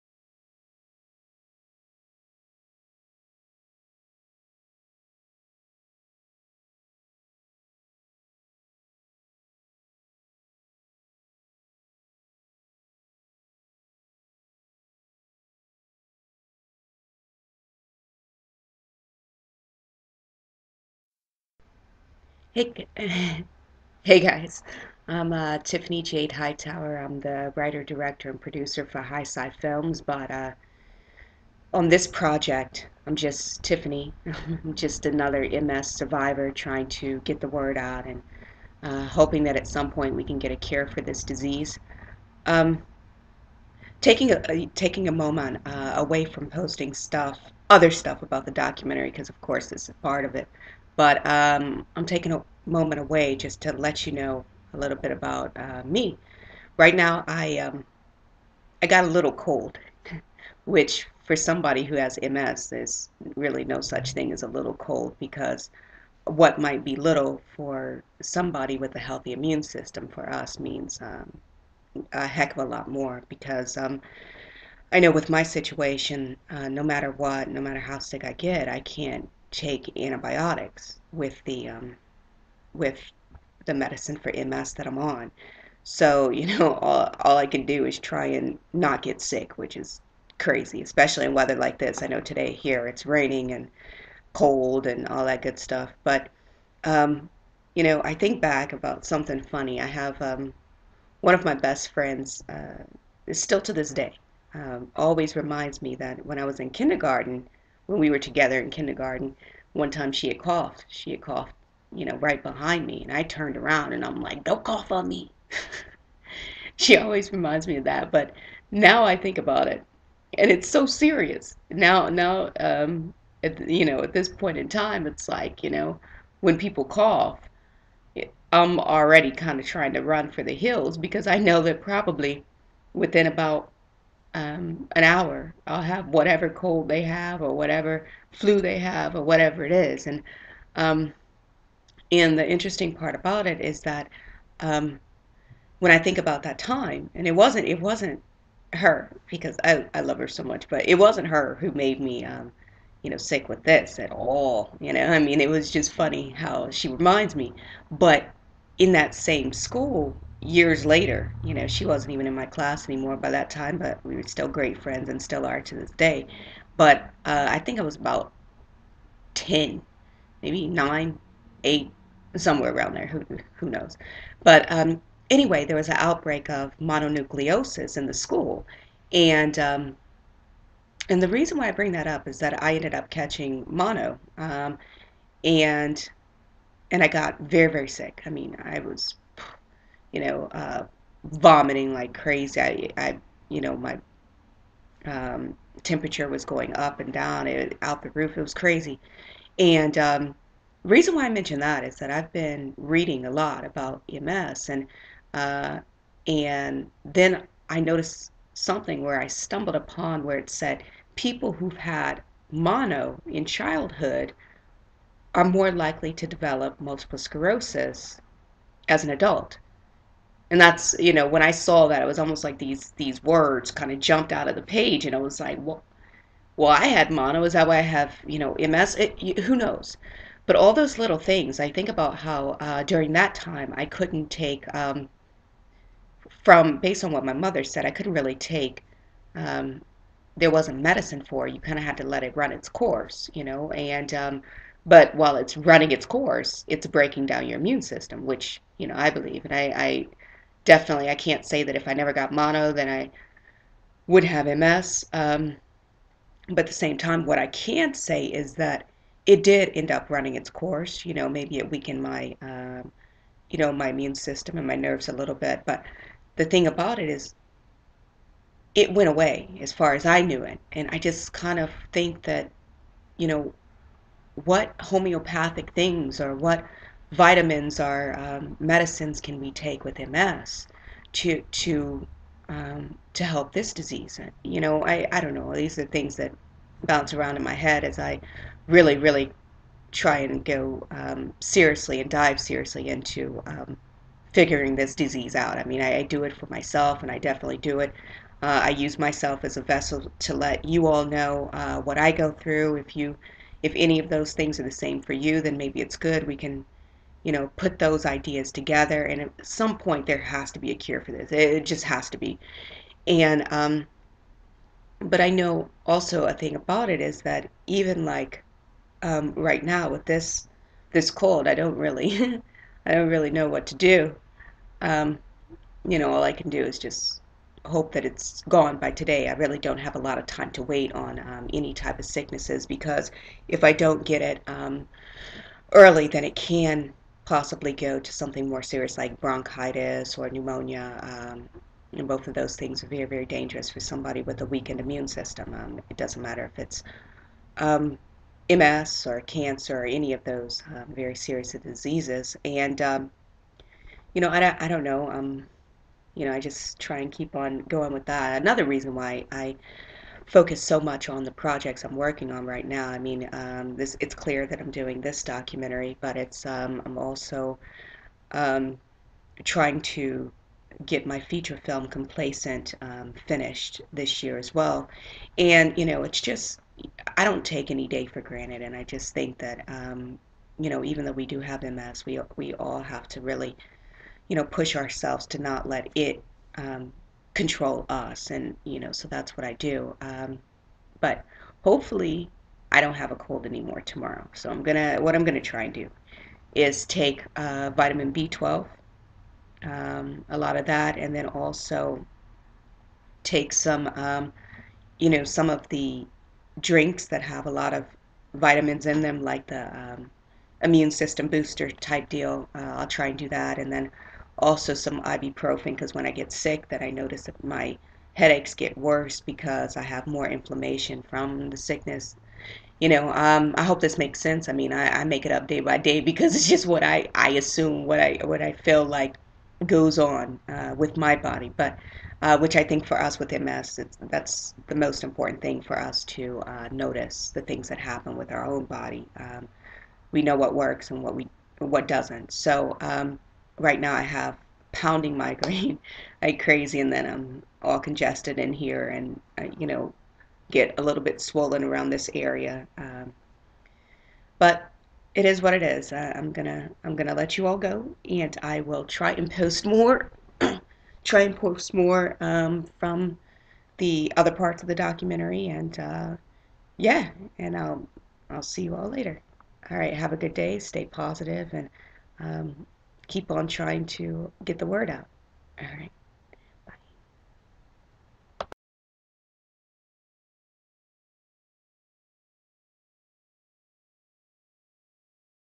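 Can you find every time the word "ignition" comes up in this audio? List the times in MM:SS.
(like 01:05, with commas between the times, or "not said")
not said.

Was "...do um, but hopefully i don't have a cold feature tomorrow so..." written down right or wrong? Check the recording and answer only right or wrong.
wrong.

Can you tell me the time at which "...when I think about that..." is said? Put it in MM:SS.
02:25.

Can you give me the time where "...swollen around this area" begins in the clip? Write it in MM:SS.
07:31.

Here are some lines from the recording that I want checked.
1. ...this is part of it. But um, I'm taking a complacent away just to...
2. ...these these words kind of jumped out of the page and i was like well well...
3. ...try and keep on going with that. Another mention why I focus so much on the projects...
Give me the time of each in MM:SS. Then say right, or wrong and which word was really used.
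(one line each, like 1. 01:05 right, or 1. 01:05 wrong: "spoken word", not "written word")
1. 00:49 wrong: "moment", not "complacent"
2. 03:42 right
3. 05:56 wrong: "reason", not "mention".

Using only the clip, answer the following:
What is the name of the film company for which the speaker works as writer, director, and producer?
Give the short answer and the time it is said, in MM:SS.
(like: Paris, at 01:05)
HighSi Films, at 00:29.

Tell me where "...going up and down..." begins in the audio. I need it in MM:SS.
03:16.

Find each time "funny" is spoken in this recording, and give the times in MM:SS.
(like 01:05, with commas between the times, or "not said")
01:39, 02:35.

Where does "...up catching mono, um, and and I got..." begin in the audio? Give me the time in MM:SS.
03:02.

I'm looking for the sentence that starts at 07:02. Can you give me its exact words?
You know, um, I hope this makes sense.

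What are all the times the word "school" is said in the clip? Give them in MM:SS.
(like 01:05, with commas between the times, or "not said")
02:39, 02:58.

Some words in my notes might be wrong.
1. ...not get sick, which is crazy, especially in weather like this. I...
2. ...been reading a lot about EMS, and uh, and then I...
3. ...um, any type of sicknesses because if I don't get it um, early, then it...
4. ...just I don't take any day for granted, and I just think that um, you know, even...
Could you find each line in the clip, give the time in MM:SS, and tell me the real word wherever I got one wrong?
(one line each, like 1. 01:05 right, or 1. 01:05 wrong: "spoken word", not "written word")
1. 01:28 right
2. 03:22 right
3. 05:31 right
4. 06:16 right.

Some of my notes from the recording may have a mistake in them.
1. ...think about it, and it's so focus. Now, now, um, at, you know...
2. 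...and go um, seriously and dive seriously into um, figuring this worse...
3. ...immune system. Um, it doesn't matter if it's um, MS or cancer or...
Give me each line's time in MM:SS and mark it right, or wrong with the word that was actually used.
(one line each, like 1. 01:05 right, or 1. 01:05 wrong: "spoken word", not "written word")
1. 01:59 wrong: "serious", not "focus"
2. 04:50 wrong: "disease", not "worse"
3. 05:44 right.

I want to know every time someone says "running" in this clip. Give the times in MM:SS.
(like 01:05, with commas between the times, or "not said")
04:05, 04:20.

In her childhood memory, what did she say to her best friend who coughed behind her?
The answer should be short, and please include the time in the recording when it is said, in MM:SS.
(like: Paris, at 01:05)
Don't cough on me, at 01:54.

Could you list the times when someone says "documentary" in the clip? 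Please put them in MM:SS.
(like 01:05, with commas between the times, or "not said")
00:48, 06:05, 07:44.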